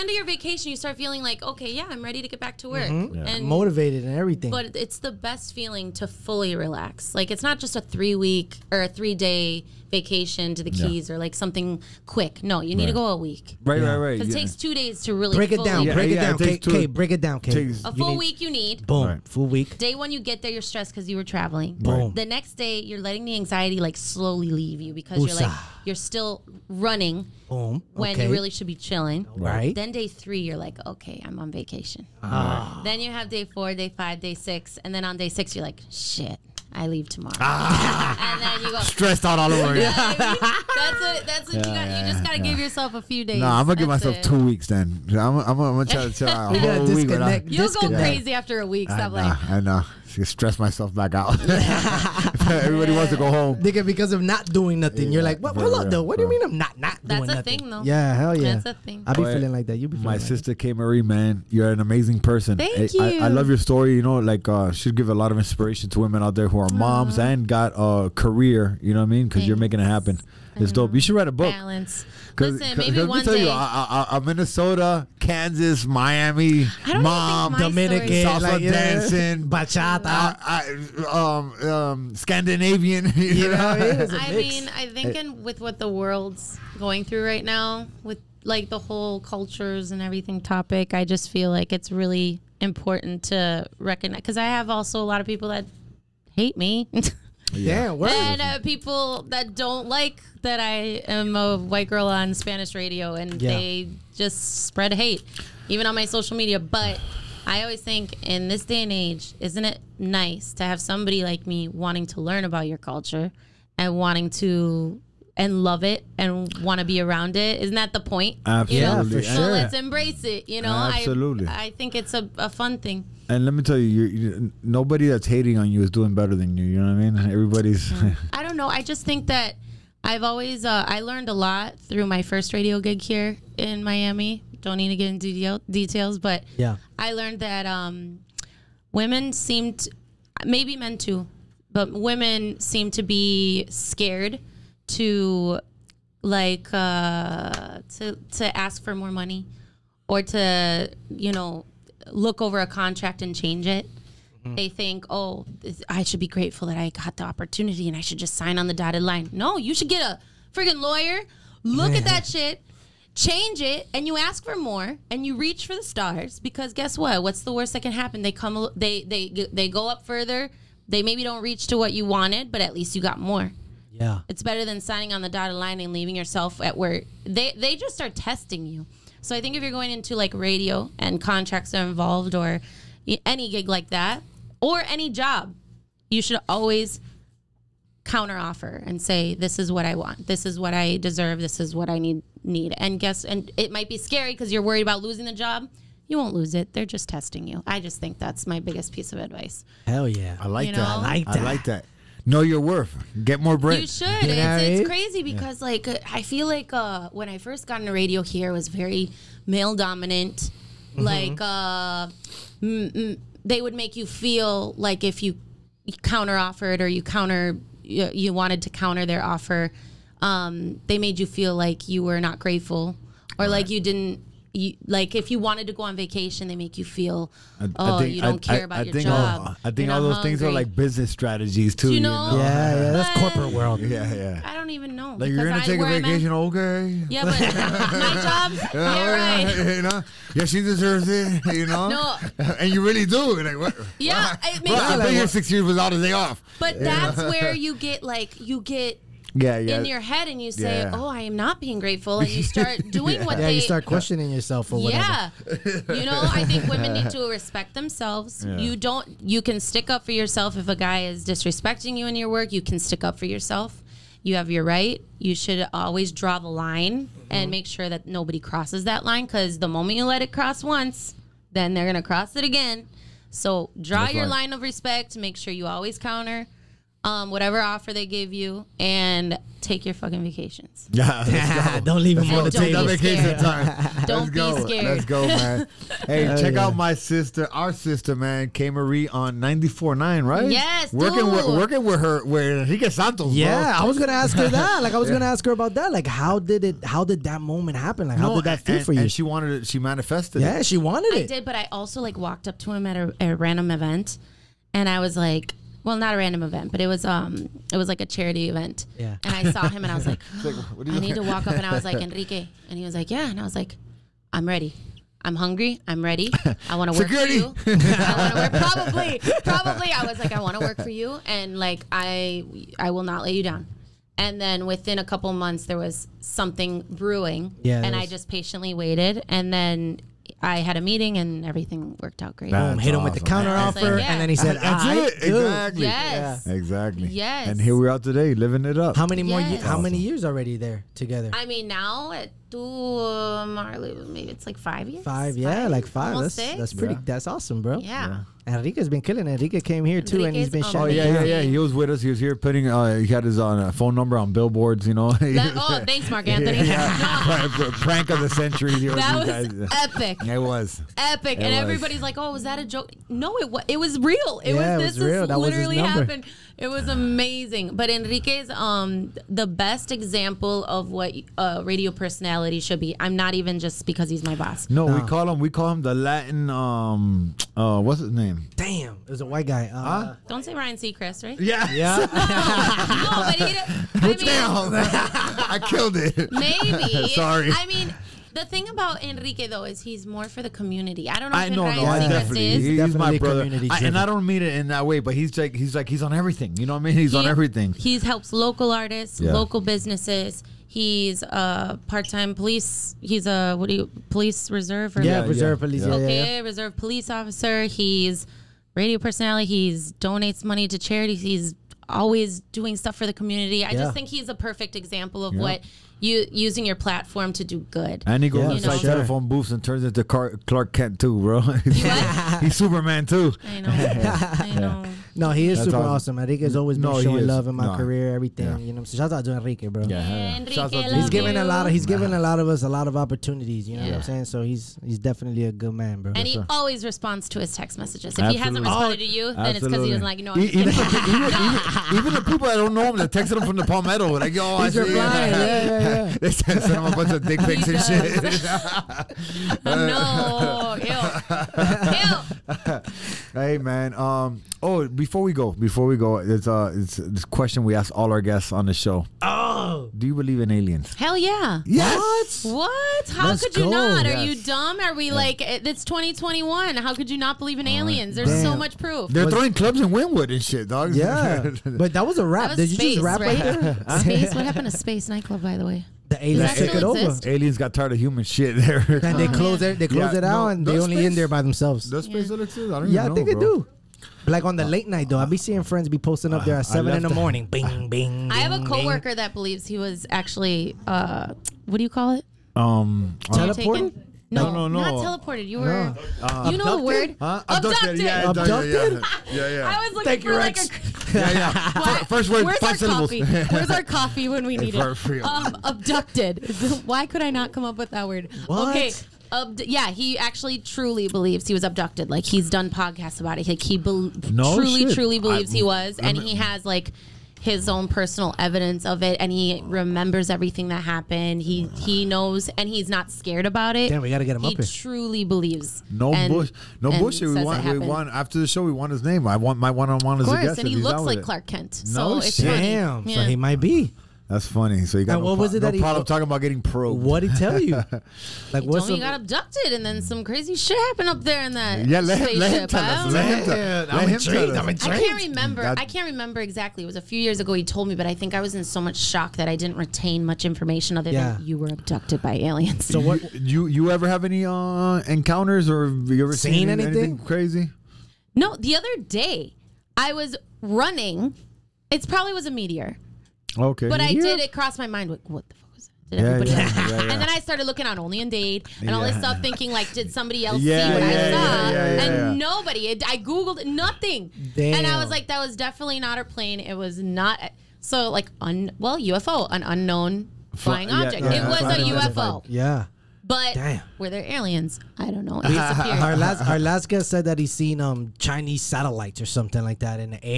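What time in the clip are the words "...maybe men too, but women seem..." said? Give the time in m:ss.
2:20.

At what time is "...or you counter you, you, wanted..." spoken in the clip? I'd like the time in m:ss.
3:36.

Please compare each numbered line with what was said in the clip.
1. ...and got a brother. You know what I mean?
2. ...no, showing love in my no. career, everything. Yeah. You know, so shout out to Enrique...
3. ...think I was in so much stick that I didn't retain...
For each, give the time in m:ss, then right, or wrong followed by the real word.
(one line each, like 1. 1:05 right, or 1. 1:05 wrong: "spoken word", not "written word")
1. 1:07 wrong: "career", not "brother"
2. 7:06 right
3. 9:08 wrong: "shock", not "stick".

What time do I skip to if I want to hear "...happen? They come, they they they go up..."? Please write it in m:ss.
2:47.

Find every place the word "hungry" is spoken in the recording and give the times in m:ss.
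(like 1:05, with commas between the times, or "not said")
3:50, 5:15.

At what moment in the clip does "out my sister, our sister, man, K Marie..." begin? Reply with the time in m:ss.
4:46.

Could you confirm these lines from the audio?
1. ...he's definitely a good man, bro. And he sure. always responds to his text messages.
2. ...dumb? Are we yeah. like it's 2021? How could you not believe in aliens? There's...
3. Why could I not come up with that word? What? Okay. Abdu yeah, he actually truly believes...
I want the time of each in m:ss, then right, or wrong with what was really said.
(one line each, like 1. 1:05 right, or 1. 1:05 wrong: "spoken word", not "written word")
1. 7:14 right
2. 7:44 right
3. 8:26 right.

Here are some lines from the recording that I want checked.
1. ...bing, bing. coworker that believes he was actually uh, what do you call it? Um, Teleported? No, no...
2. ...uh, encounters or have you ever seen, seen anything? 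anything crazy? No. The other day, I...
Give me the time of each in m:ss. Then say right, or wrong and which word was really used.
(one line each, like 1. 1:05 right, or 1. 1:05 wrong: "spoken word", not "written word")
1. 8:08 right
2. 9:14 right.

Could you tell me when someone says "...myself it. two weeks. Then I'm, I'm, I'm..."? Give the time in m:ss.
0:43.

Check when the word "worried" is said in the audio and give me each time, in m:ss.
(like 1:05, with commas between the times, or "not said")
3:14.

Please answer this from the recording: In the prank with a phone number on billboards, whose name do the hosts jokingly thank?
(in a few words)
Marc Anthony.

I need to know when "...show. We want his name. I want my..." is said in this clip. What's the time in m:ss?
8:48.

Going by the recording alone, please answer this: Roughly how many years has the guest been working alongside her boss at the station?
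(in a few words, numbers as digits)
5.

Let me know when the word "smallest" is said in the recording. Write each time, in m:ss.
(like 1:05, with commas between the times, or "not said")
not said.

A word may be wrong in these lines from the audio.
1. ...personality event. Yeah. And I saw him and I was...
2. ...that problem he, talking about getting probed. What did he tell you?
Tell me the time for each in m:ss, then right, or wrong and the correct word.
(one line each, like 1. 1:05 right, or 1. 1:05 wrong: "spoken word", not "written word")
1. 5:08 wrong: "charity", not "personality"
2. 8:55 right.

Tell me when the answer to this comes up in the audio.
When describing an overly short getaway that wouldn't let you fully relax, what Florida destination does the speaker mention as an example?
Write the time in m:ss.
0:10.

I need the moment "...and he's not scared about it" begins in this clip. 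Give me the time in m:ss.
8:42.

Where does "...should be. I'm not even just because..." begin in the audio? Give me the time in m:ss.
6:12.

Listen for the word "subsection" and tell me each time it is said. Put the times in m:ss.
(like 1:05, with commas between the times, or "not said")
not said.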